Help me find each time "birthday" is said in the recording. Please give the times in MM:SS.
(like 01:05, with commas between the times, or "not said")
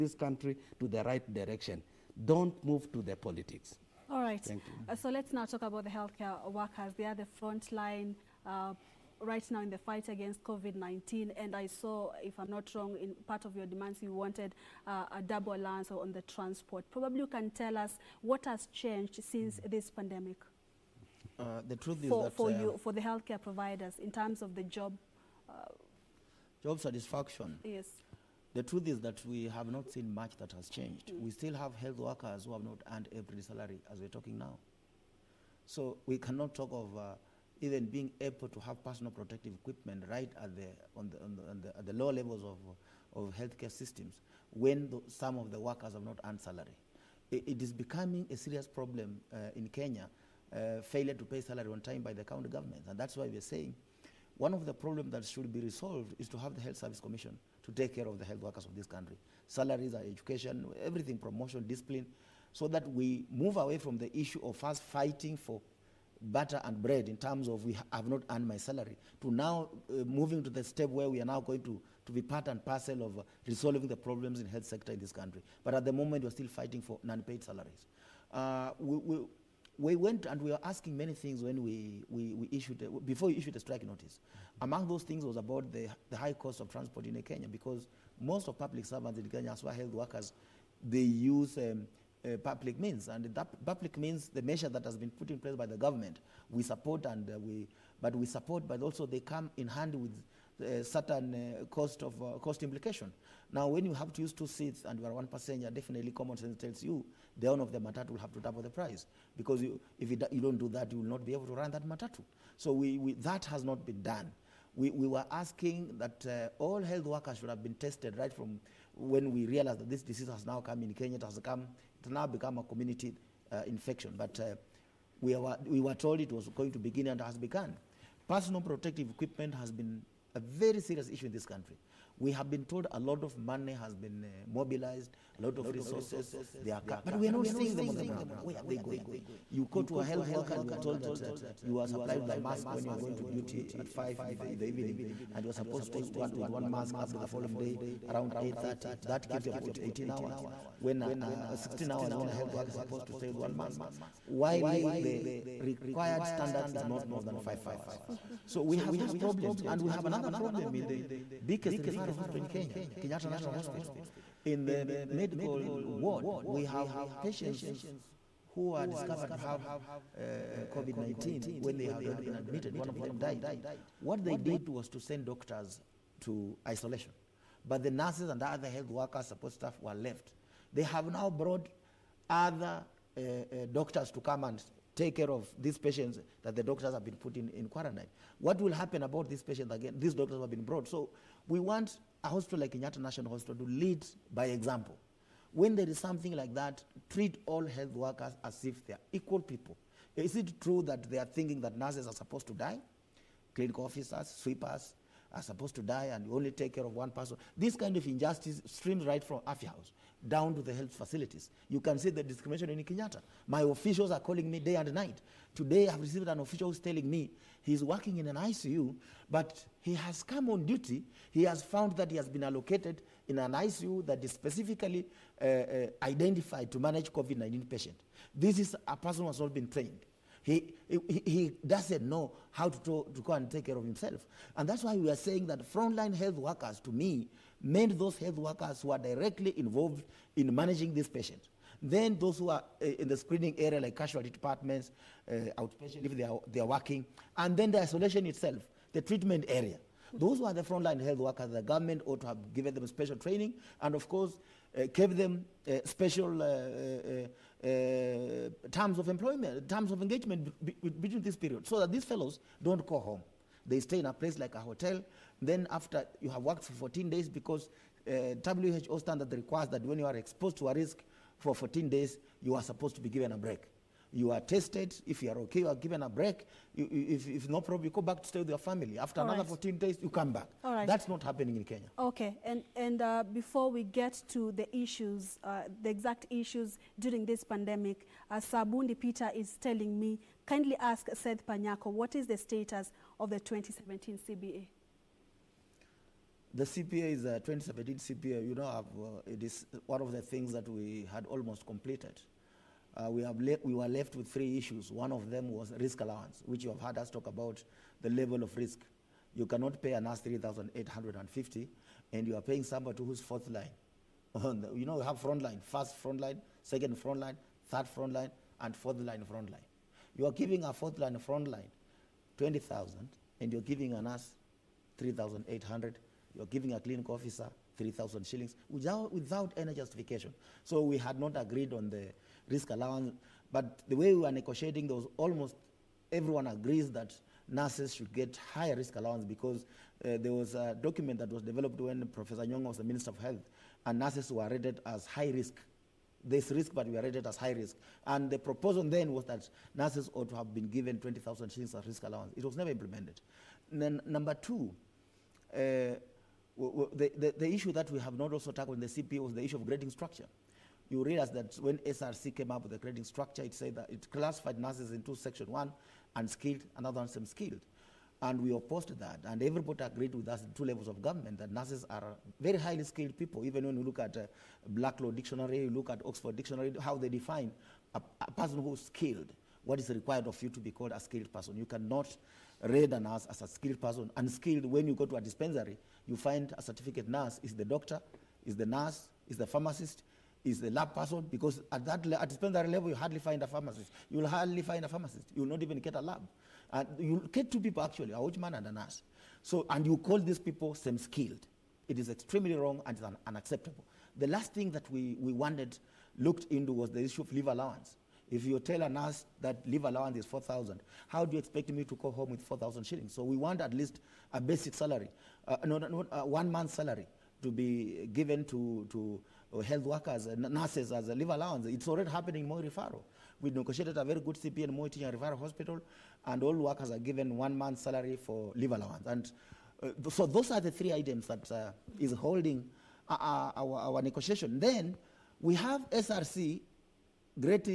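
not said.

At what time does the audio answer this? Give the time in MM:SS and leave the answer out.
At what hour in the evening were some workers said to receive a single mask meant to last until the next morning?
02:23.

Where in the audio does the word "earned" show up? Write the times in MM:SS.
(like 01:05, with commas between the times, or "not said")
00:32, 00:46, 01:08.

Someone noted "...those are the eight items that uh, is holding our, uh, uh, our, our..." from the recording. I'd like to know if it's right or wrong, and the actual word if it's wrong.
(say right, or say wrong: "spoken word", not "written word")
wrong: "three", not "eight".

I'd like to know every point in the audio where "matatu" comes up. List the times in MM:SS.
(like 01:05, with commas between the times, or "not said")
01:47, 01:51.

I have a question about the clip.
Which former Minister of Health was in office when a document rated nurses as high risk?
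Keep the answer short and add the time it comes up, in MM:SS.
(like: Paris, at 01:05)
Professor Nyong'o, at 05:42.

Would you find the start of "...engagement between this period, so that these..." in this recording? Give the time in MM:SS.
04:20.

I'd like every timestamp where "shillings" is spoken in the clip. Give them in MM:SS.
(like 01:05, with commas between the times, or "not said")
05:28, 05:51, 06:52.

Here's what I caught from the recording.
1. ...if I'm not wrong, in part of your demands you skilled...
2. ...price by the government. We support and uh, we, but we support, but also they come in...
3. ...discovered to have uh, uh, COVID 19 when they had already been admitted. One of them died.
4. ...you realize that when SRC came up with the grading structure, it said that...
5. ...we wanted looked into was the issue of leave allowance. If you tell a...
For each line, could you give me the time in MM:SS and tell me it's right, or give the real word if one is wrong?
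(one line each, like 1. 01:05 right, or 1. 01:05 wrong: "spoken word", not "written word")
1. 00:12 wrong: "wanted", not "skilled"
2. 01:35 wrong: "place", not "price"
3. 02:48 right
4. 06:00 right
5. 06:45 right.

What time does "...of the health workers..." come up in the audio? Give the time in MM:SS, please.
00:58.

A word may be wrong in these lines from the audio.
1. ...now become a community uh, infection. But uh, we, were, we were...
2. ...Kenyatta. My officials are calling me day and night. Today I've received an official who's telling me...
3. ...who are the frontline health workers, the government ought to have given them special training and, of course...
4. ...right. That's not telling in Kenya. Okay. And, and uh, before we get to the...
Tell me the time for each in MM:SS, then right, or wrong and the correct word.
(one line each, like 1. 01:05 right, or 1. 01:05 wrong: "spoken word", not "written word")
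1. 02:02 right
2. 03:32 right
3. 04:10 right
4. 04:40 wrong: "happening", not "telling".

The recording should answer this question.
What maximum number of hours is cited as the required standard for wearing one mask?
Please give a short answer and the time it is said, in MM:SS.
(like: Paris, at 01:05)
5, at 02:36.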